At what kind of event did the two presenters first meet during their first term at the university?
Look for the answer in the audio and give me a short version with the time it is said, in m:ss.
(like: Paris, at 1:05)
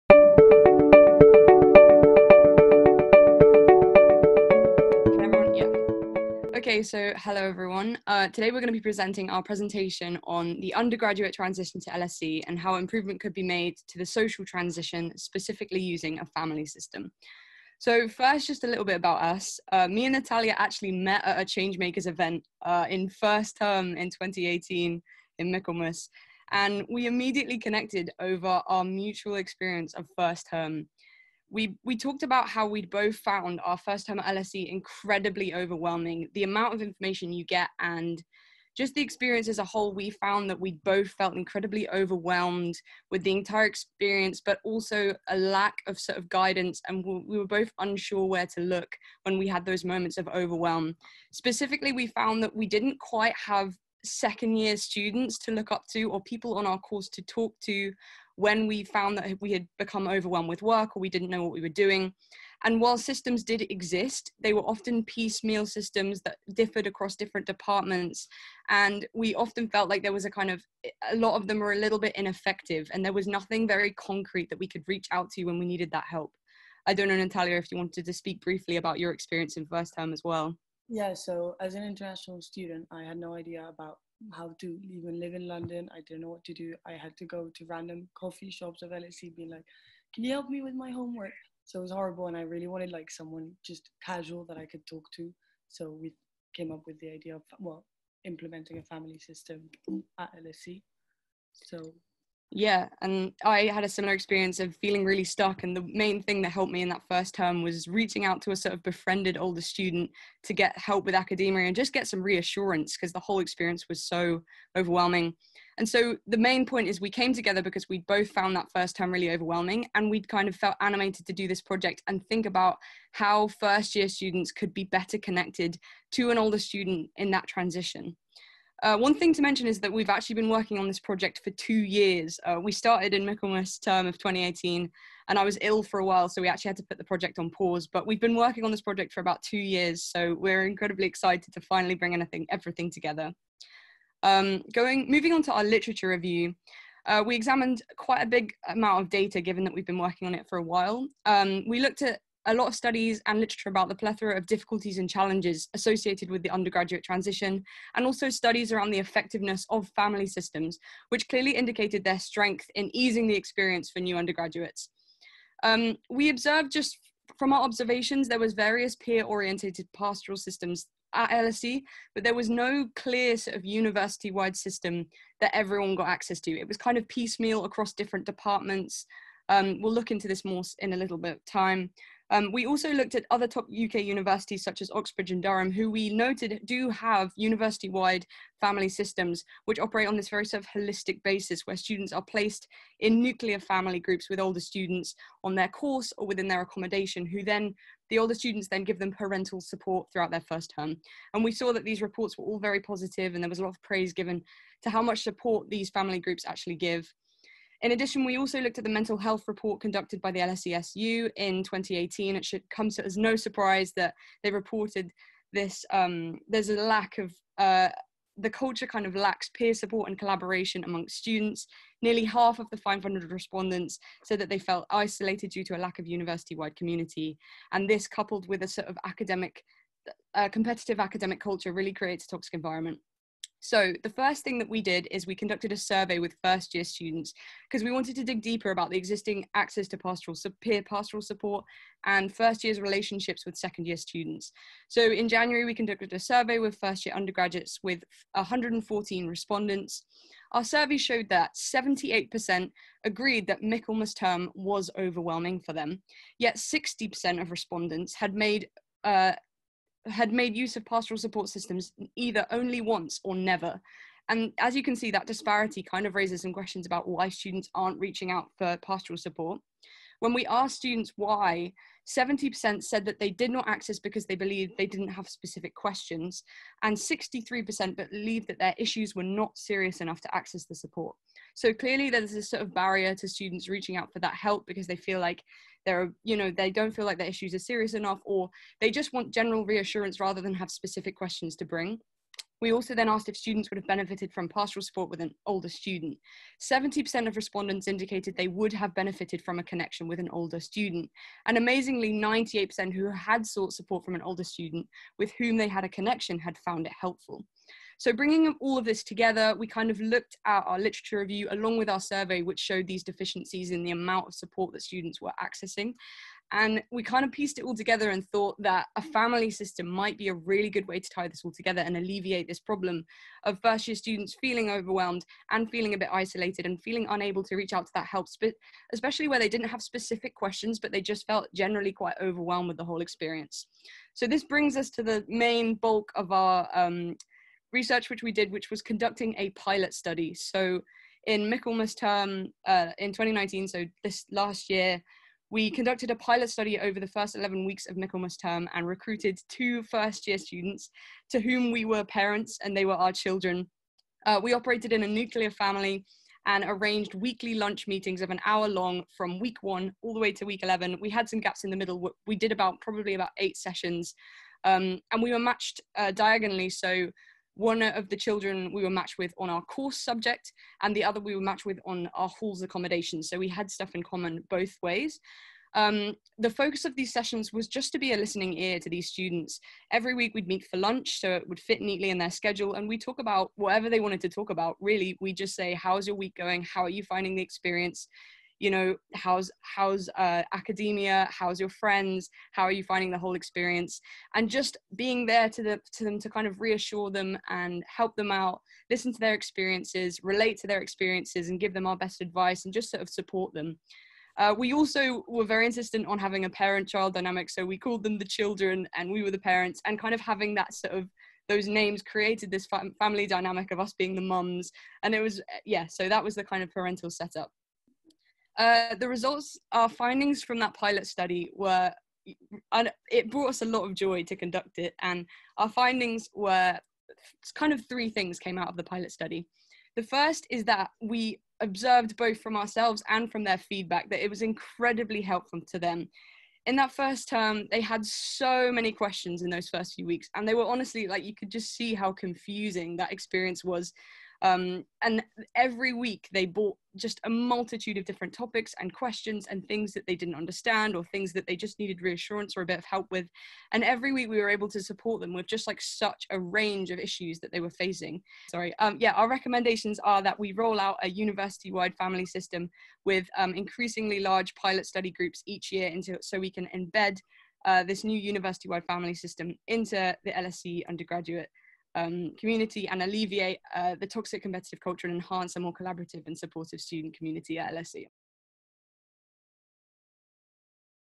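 Changemakers event, at 0:21.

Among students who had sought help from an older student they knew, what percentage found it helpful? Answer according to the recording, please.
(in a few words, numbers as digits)
98%.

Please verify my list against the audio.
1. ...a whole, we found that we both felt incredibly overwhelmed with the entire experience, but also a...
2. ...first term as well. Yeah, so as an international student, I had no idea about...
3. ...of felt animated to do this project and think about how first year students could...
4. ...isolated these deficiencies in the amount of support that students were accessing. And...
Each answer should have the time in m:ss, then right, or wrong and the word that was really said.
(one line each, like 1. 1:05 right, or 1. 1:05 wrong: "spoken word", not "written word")
1. 0:39 right
2. 1:19 right
3. 2:00 right
4. 5:12 wrong: "showed", not "isolated".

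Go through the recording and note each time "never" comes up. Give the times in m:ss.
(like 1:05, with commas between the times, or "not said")
4:23.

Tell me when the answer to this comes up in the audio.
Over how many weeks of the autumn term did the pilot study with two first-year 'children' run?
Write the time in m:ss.
5:47.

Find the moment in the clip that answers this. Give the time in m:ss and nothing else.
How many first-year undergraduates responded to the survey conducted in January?
4:08.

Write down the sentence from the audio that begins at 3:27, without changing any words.
In addition, we also looked at the mental health report conducted by the LSESU in 2018.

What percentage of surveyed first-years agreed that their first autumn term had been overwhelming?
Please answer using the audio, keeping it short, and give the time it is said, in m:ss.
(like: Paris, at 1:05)
78%, at 4:11.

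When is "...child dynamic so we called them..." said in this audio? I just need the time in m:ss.
6:46.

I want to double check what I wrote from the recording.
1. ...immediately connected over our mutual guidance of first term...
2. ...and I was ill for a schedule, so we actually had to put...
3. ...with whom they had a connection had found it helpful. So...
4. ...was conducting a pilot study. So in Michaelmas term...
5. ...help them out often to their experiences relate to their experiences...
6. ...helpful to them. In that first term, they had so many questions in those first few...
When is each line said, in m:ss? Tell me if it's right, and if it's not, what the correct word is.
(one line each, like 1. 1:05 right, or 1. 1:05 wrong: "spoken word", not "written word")
1. 0:27 wrong: "experience", not "guidance"
2. 2:15 wrong: "while", not "schedule"
3. 5:05 right
4. 5:38 right
5. 6:37 wrong: "listen", not "often"
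6. 7:15 right.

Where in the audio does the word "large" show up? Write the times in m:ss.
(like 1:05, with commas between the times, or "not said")
7:44.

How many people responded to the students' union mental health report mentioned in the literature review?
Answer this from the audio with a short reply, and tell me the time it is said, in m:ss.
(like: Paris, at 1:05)
500, at 3:42.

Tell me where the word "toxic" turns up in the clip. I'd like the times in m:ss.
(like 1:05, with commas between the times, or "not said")
3:52, 7:54.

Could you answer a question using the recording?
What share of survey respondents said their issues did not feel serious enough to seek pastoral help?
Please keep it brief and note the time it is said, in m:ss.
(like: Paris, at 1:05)
63%, at 4:36.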